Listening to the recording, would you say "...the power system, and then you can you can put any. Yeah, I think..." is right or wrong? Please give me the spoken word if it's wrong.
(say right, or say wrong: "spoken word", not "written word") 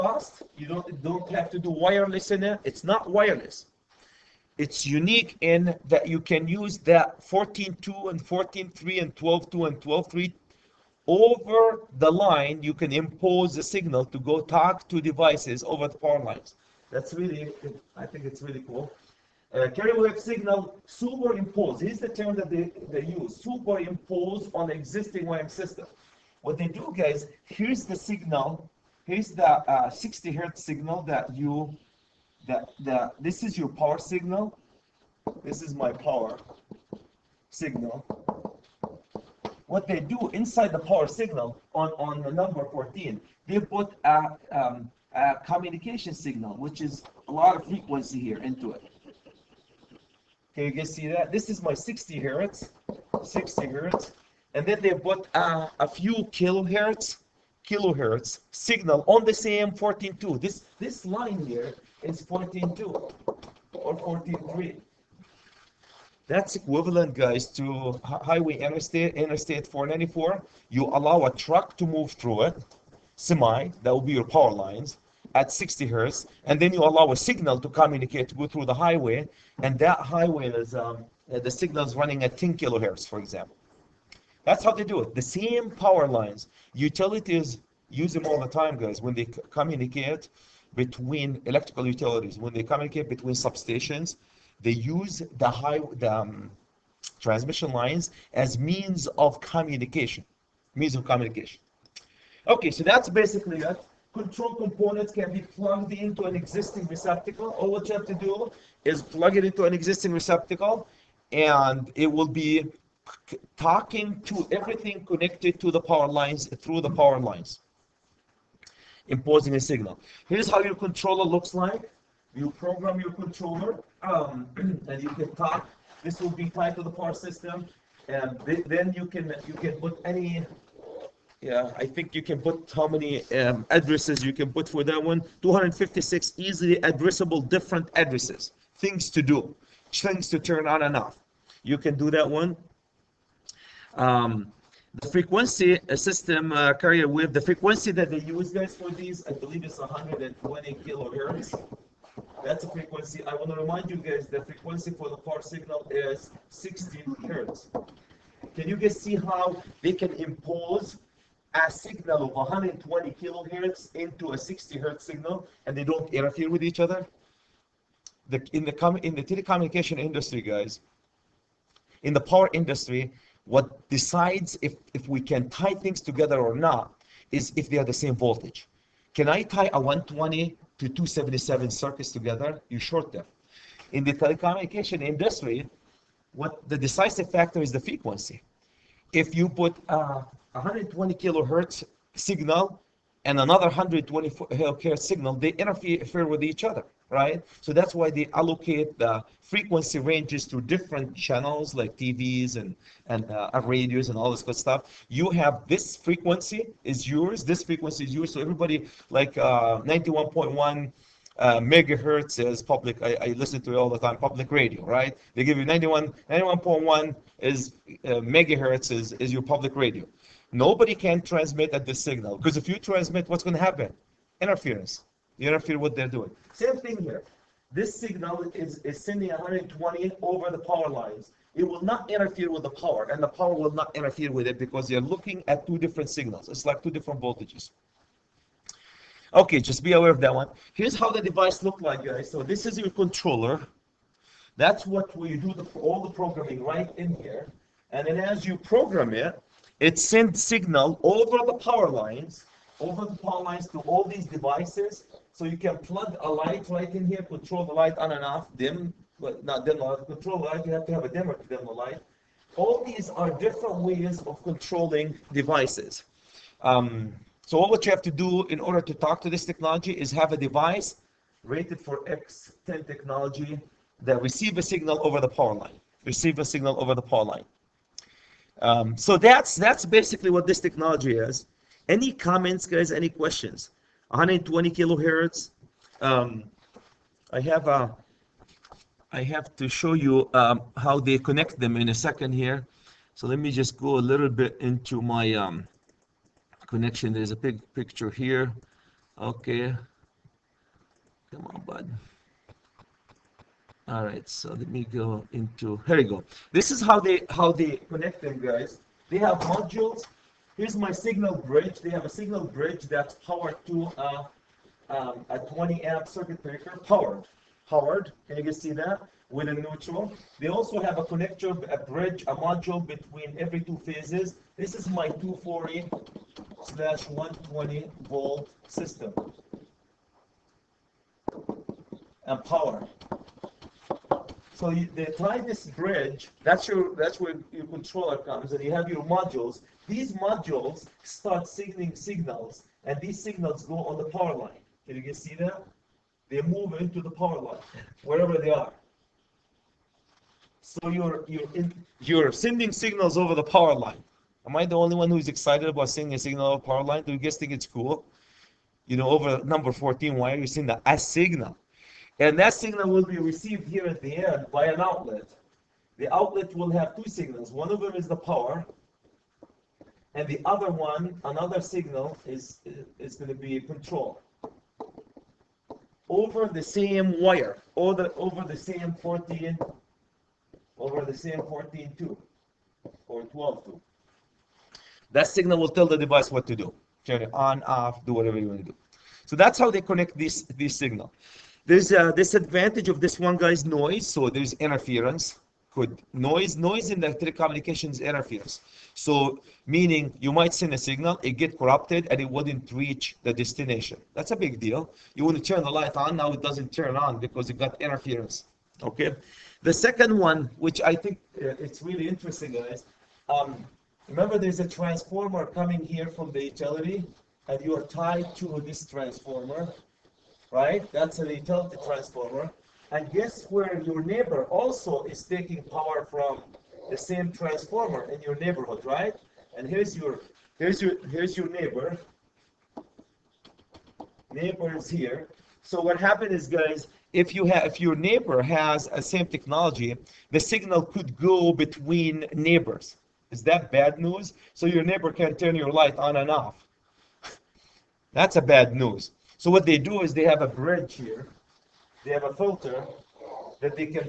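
right.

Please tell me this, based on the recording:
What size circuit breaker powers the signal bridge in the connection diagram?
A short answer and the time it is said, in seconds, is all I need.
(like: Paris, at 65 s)
20 amp, at 315 s.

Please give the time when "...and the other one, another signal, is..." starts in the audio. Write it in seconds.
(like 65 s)
370 s.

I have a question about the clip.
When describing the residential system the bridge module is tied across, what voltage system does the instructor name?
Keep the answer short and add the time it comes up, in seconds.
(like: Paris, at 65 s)
240/120 volt, at 325 s.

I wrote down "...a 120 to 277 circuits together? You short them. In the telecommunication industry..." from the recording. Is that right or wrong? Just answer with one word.
right.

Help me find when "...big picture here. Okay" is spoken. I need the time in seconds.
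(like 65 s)
297 s.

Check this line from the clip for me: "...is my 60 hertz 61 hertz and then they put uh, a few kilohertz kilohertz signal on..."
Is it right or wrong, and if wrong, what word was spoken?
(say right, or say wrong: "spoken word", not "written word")
wrong: "60", not "61".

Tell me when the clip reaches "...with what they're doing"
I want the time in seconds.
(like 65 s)
225 s.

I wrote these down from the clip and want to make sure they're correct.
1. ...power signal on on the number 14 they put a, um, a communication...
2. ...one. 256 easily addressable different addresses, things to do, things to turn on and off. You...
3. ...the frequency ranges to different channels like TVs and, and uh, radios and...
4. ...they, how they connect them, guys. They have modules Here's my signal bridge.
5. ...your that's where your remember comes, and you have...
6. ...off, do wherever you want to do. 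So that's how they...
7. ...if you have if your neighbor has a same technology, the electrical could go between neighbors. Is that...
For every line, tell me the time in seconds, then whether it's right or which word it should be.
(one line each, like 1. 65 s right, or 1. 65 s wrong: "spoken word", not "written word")
1. 40 s right
2. 135 s right
3. 198 s right
4. 307 s right
5. 336 s wrong: "controller", not "remember"
6. 387 s wrong: "whatever", not "wherever"
7. 437 s wrong: "signal", not "electrical".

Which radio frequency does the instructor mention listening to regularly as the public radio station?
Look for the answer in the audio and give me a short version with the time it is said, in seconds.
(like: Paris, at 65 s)
91.1 megahertz, at 209 s.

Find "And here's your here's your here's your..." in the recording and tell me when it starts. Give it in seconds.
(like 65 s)
429 s.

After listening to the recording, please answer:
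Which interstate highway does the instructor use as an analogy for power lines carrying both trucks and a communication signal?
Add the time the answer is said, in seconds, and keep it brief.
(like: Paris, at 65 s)
Interstate 494, at 69 s.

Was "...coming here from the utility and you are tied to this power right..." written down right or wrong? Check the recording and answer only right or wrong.
wrong.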